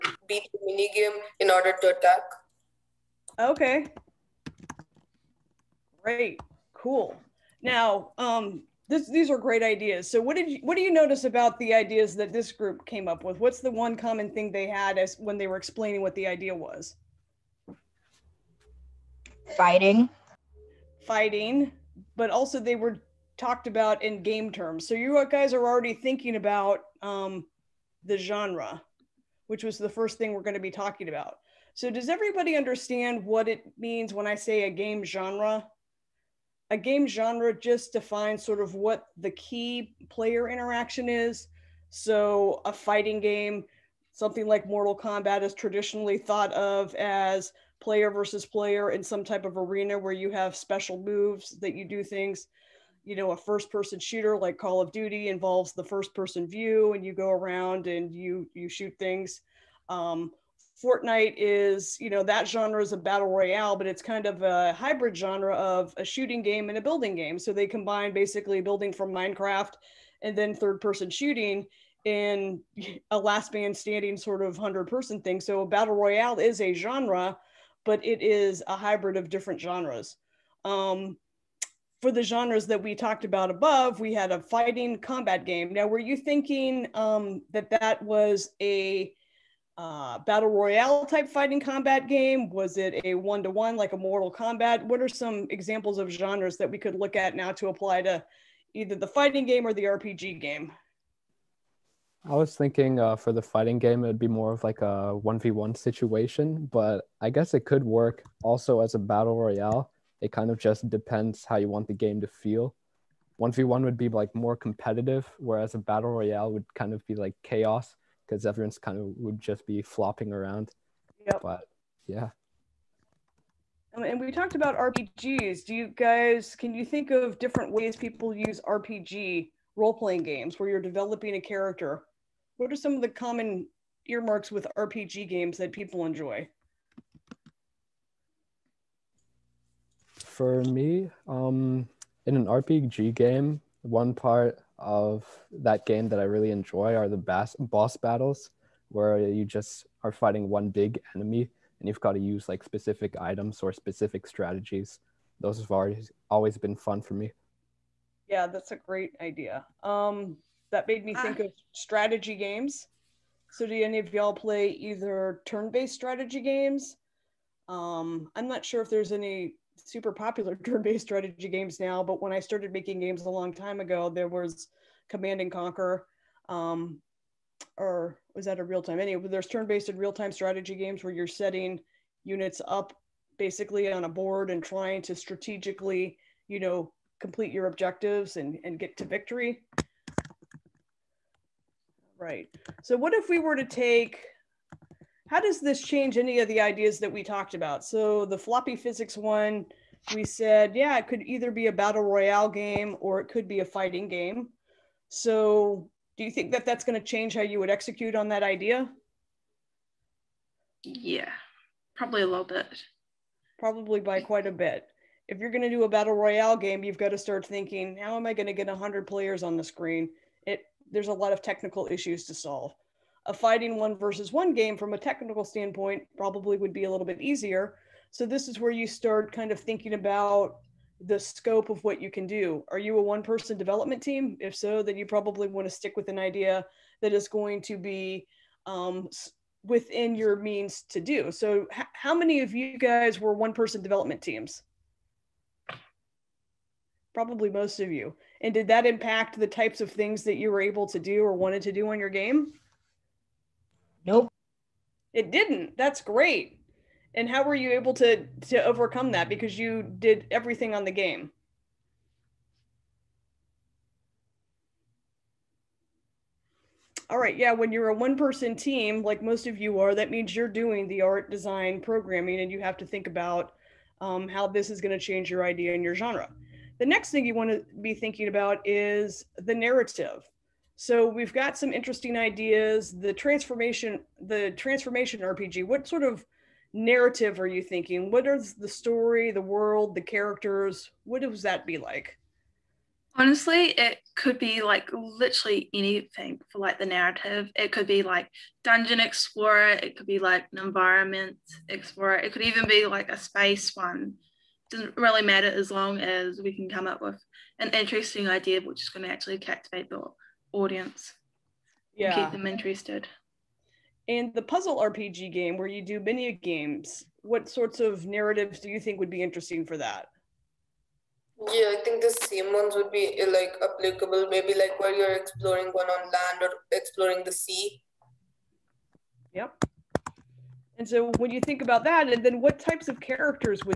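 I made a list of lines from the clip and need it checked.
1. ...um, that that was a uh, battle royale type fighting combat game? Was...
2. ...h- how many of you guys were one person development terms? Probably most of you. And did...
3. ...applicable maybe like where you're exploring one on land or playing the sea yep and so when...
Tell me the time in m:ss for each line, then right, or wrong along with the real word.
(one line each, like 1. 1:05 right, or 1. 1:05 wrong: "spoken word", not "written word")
1. 1:26 right
2. 4:01 wrong: "teams", not "terms"
3. 5:23 wrong: "exploring", not "playing".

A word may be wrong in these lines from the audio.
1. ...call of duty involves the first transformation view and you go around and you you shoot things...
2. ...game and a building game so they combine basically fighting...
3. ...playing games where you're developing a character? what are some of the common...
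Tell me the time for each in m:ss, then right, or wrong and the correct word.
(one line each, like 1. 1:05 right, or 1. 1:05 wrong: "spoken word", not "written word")
1. 0:54 wrong: "person", not "transformation"
2. 1:06 wrong: "building", not "fighting"
3. 2:09 right.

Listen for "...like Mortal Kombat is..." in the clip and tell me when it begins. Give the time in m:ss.
0:44.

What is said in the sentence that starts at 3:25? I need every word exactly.
So do you think that that's going to change how you would execute on that idea?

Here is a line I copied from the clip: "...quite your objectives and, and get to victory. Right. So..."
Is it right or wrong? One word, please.
wrong.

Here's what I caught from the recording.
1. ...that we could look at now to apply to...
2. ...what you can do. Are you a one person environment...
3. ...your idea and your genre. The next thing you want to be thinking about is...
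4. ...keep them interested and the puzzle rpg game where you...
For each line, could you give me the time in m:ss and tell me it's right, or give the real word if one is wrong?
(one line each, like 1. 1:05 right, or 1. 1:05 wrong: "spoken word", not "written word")
1. 1:36 right
2. 3:51 wrong: "development", not "environment"
3. 4:35 right
4. 5:12 right.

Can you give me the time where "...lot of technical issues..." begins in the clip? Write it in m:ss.
3:41.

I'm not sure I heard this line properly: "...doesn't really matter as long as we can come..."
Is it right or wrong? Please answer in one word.
right.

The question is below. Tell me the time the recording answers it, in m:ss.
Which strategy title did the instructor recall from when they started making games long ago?
2:55.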